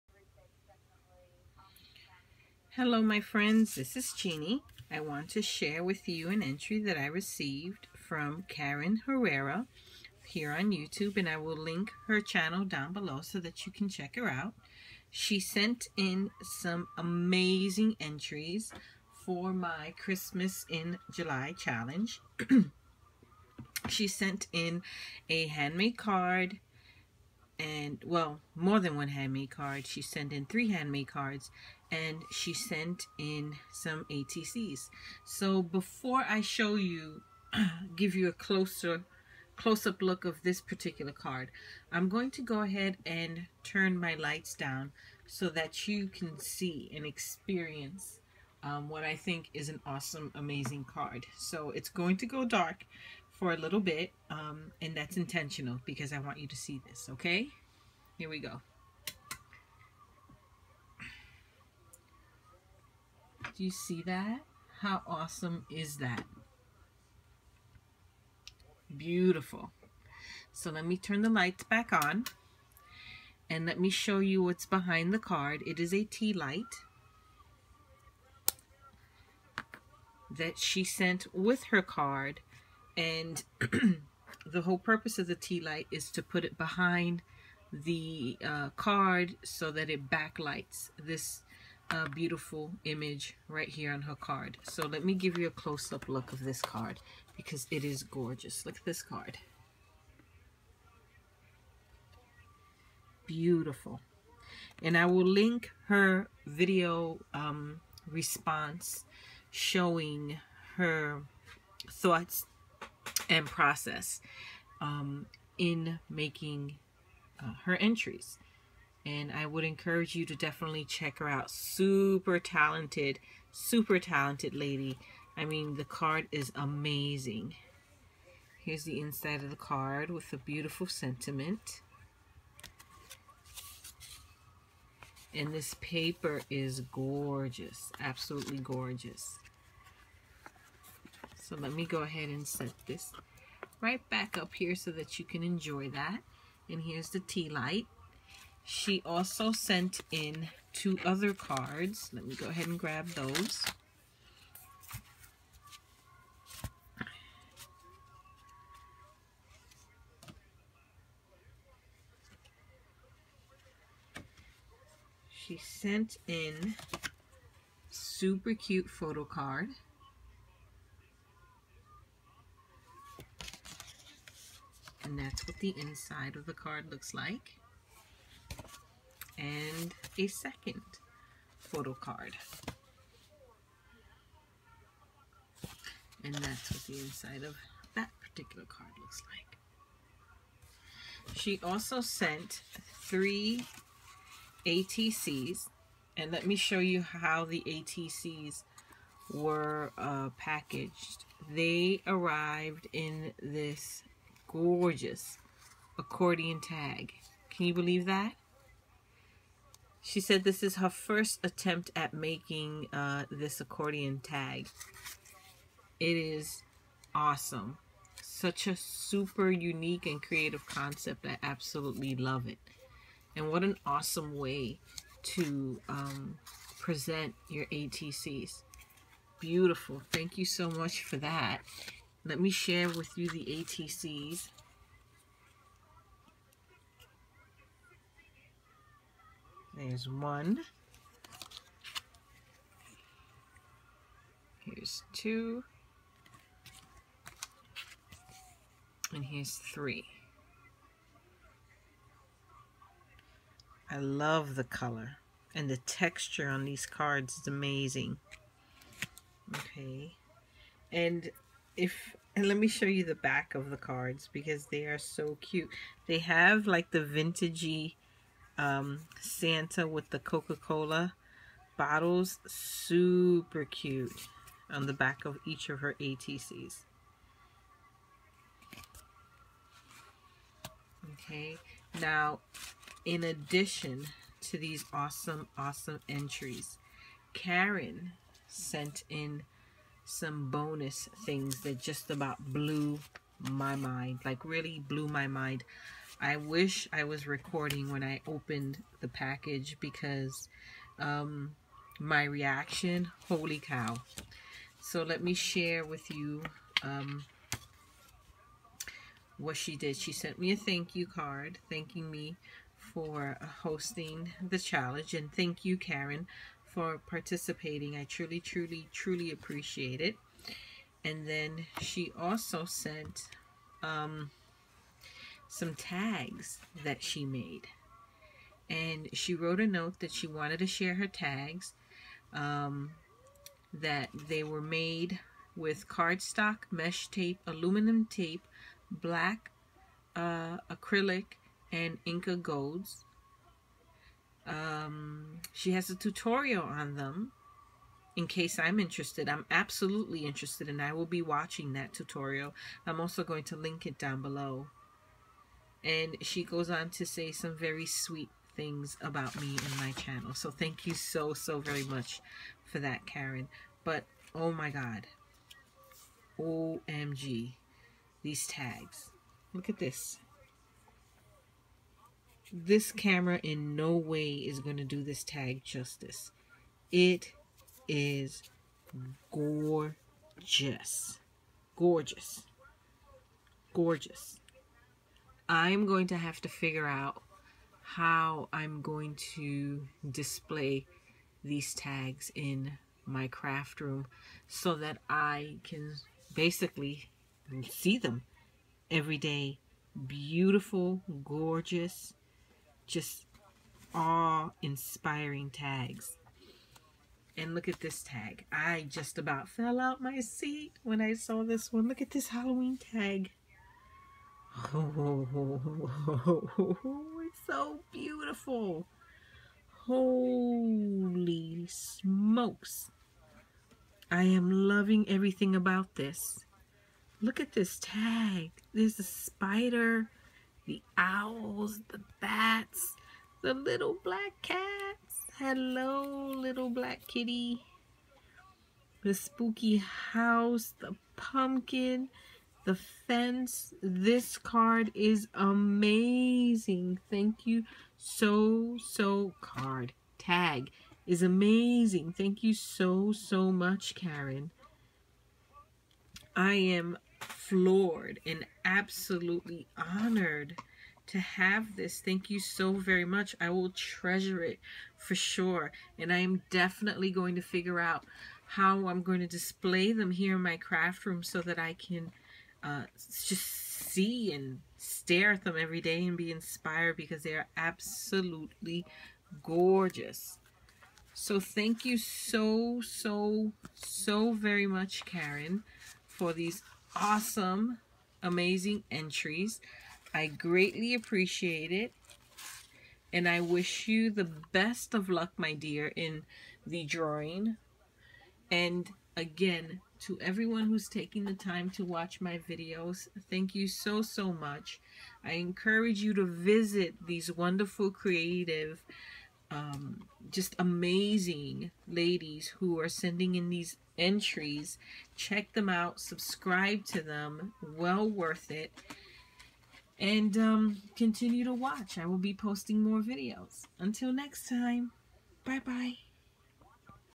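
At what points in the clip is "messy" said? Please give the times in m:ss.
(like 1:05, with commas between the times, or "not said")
not said.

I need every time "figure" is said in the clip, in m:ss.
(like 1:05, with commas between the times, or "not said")
6:26, 7:47.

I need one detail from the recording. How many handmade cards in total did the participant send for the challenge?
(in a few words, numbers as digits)
3.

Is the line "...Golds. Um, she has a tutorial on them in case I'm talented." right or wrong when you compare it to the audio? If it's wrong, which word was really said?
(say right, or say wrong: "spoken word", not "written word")
wrong: "interested", not "talented".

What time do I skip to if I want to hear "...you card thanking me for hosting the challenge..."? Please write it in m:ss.
5:10.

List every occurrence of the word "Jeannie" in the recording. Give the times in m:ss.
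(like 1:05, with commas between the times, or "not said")
0:04.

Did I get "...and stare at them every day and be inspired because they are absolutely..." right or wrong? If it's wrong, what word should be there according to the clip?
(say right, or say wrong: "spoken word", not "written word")
right.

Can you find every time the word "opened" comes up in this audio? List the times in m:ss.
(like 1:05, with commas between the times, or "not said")
4:58.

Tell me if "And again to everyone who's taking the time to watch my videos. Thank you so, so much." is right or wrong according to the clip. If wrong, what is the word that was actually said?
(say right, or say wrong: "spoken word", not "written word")
right.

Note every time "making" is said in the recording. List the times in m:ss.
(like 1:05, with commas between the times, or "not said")
1:56, 3:32.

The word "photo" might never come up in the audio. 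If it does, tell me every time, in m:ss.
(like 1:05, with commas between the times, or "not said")
2:48, 3:01.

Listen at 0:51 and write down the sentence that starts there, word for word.
So it's going to go dark for a little bit, um, and that's intentional because I want you to see this, okay?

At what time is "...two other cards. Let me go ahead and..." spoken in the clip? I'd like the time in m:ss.
2:30.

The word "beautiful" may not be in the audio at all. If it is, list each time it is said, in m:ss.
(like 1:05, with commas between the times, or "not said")
1:08, 1:32, 1:43, 2:10, 3:49, 6:40, 6:57.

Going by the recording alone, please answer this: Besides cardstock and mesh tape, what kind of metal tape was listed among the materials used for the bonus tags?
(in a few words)
Aluminum tape.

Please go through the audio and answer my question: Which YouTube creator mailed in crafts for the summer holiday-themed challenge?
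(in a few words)
Karen Herrera.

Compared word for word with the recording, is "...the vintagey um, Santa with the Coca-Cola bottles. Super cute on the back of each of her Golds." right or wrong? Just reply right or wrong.
wrong.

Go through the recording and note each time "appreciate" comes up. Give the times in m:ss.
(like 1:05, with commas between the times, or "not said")
5:19, 8:10.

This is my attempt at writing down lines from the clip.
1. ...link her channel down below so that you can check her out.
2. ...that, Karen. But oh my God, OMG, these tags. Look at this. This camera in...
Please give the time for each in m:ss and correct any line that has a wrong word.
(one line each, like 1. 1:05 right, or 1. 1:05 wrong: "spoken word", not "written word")
1. 0:11 right
2. 6:02 right.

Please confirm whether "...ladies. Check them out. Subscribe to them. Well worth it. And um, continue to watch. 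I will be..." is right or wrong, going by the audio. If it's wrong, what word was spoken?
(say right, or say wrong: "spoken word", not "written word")
wrong: "entries", not "ladies".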